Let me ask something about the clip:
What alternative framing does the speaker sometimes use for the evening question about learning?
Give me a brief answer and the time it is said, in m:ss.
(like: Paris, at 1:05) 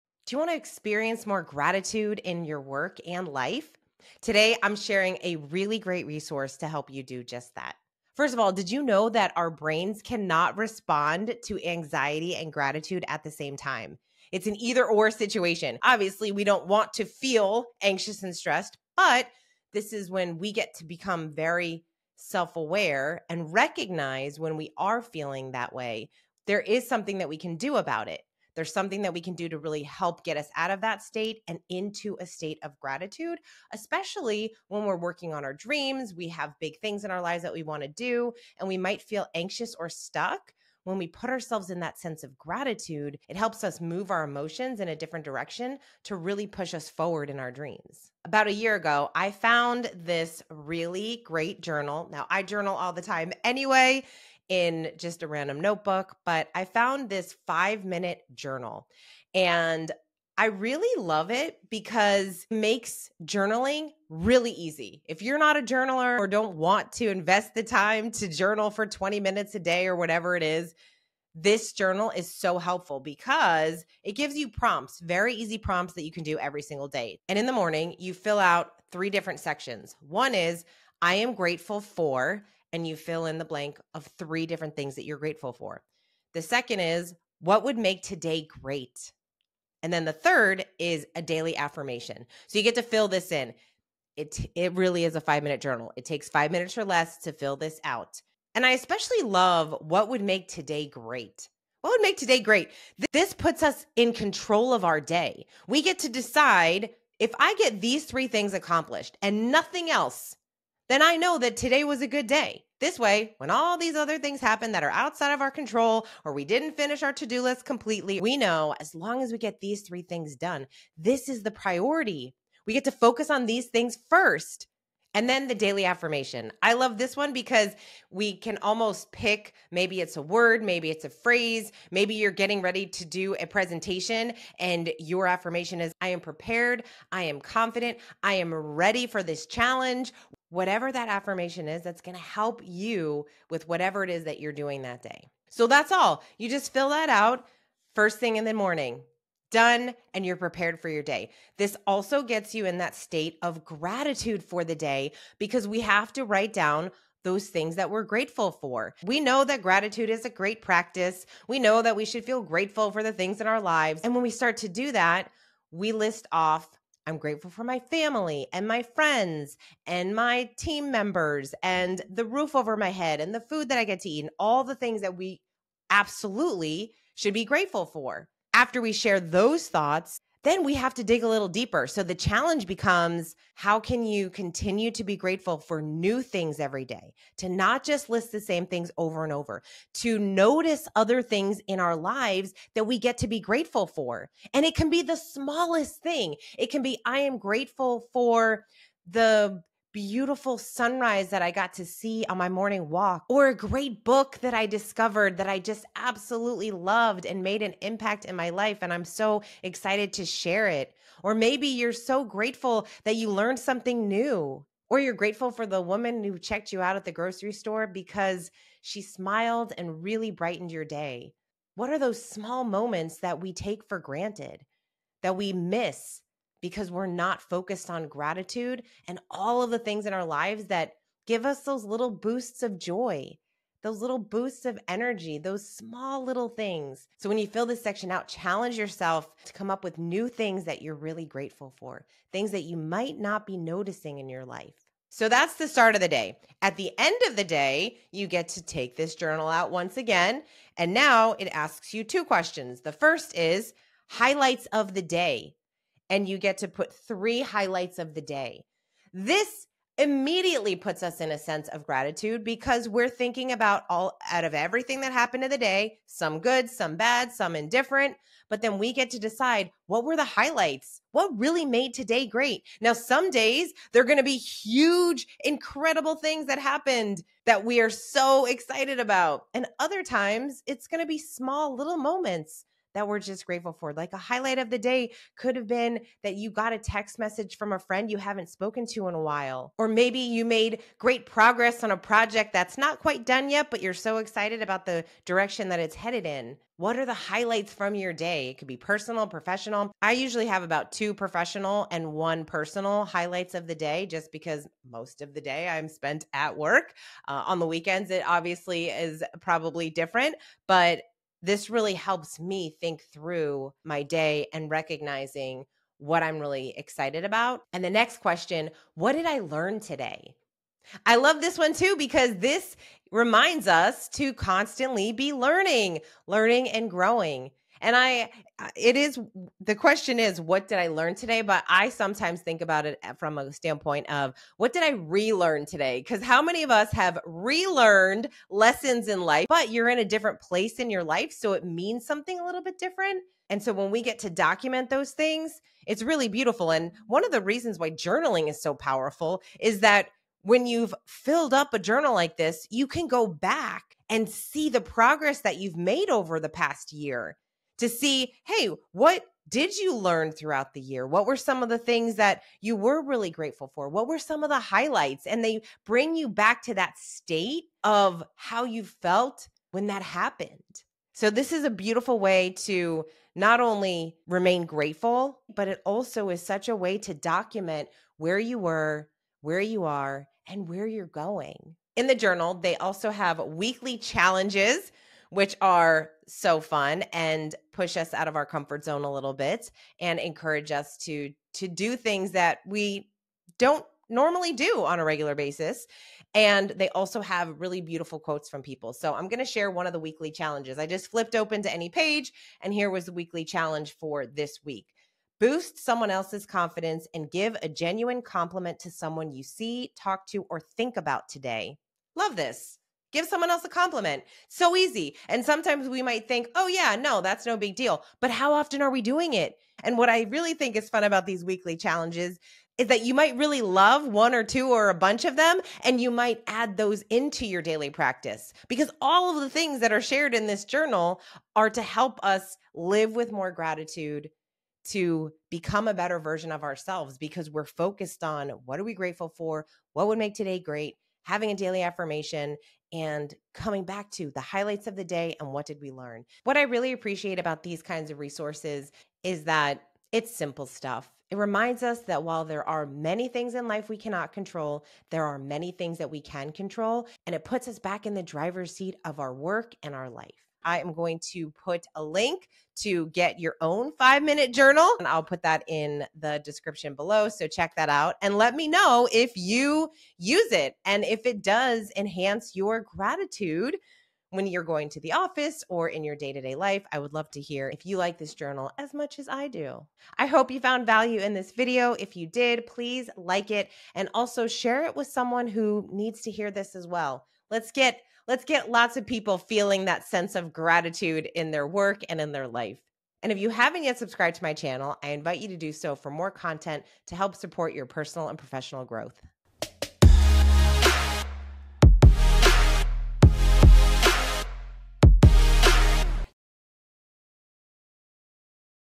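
what did I relearn today, at 5:34.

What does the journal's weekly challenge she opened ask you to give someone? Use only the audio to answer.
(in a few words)
a genuine compliment.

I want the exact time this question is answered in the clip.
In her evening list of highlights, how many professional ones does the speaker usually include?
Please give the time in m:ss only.
5:00.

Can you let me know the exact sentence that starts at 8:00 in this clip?
I hope you found value in this video.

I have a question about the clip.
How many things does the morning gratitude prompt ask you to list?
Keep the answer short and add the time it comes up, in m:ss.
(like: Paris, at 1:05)
3, at 1:24.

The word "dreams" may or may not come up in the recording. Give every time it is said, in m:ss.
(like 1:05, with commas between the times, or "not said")
0:35, 0:47.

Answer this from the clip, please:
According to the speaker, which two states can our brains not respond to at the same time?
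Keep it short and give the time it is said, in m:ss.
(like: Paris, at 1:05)
anxiety and gratitude, at 0:11.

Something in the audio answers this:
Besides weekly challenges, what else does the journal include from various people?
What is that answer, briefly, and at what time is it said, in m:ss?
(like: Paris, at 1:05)
beautiful quotes, at 6:37.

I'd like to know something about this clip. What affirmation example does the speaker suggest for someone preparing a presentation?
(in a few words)
I am prepared.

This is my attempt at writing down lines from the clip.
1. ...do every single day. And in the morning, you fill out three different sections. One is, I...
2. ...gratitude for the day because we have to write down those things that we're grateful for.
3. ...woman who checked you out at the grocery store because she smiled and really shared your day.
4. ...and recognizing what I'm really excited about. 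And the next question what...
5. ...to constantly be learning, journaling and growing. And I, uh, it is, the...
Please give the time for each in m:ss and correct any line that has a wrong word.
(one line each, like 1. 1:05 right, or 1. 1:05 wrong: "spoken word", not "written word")
1. 1:16 right
2. 2:33 right
3. 3:35 wrong: "brightened", not "shared"
4. 5:14 right
5. 5:24 wrong: "learning", not "journaling".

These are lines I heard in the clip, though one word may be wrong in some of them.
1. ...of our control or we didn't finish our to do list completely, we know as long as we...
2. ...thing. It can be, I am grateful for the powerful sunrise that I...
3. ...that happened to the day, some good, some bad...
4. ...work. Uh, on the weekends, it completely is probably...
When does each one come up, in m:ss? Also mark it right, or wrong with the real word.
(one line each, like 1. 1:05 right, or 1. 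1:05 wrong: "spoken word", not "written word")
1. 1:55 right
2. 3:16 wrong: "beautiful", not "powerful"
3. 4:25 right
4. 5:06 wrong: "obviously", not "completely".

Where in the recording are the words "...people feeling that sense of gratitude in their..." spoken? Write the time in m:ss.
8:09.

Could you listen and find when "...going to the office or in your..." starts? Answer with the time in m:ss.
7:54.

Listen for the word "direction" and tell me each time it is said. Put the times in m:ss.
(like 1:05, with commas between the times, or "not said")
0:45, 4:55.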